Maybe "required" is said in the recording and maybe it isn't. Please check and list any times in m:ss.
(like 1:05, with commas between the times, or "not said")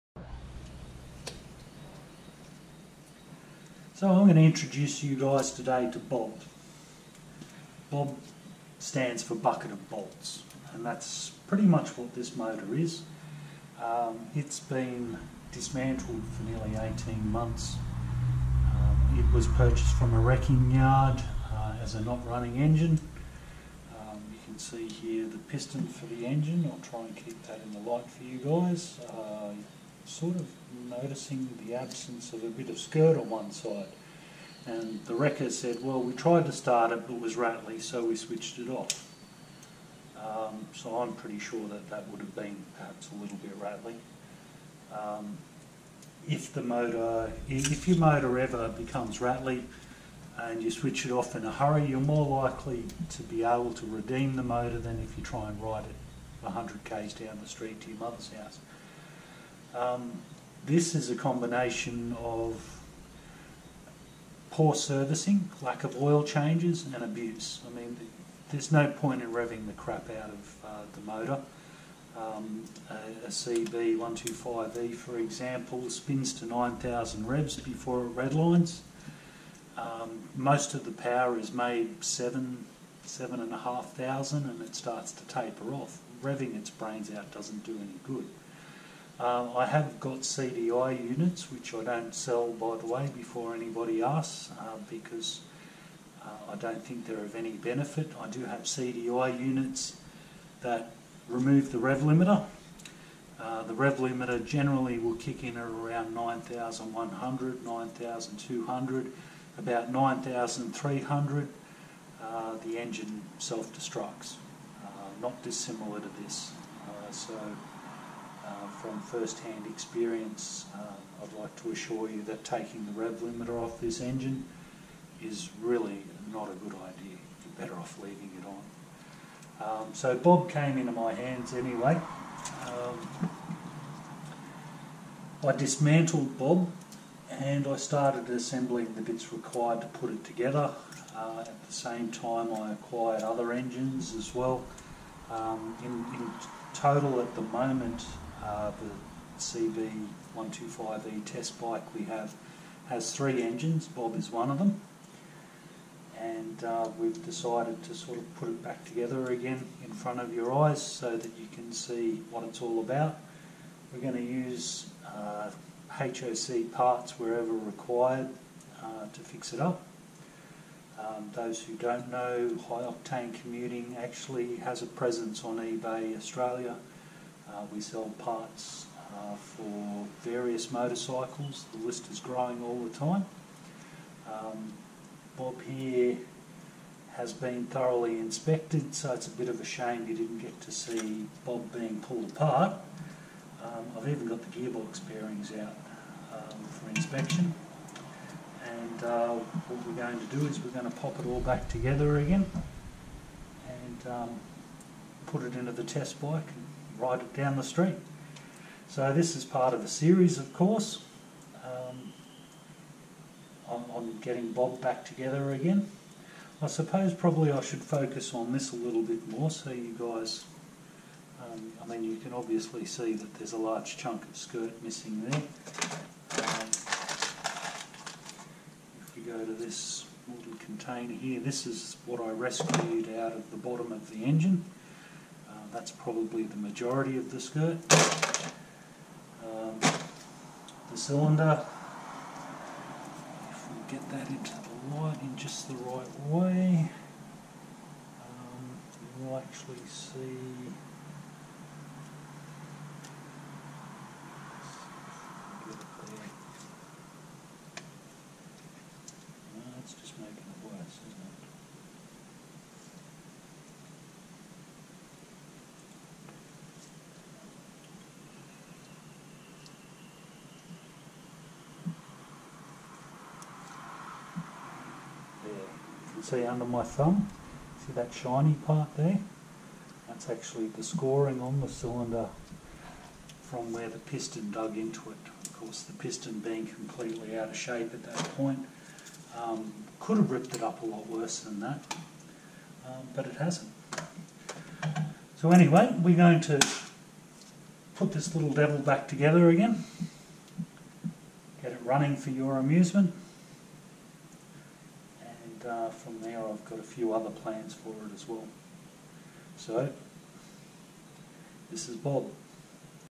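2:19, 2:47.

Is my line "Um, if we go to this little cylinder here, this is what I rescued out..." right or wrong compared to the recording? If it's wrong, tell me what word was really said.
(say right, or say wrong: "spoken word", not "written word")
wrong: "container", not "cylinder".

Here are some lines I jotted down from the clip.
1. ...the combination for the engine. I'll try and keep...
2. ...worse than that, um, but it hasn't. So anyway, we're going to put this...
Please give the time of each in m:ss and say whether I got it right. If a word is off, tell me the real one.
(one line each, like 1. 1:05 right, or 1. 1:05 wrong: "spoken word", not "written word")
1. 0:25 wrong: "piston", not "combination"
2. 4:51 right.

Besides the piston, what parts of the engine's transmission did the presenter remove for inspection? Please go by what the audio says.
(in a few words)
gearbox bearings.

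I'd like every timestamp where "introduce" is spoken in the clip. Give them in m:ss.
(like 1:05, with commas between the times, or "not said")
0:04.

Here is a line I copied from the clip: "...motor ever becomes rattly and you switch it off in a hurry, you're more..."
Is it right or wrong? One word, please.
right.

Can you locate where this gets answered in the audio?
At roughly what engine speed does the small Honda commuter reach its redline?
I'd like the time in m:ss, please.
1:16.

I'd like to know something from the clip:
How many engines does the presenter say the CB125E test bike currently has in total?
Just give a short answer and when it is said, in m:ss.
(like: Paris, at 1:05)
3, at 2:33.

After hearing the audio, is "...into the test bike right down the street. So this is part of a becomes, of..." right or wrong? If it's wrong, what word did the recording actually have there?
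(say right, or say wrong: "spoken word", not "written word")
wrong: "series", not "becomes".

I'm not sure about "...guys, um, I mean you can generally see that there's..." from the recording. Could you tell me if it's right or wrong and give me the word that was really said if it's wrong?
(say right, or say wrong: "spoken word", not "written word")
wrong: "obviously", not "generally".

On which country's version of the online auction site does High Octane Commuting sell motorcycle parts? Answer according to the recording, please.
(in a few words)
Australia.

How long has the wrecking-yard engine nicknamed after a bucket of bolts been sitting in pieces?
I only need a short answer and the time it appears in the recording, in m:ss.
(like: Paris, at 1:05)
18 months, at 0:17.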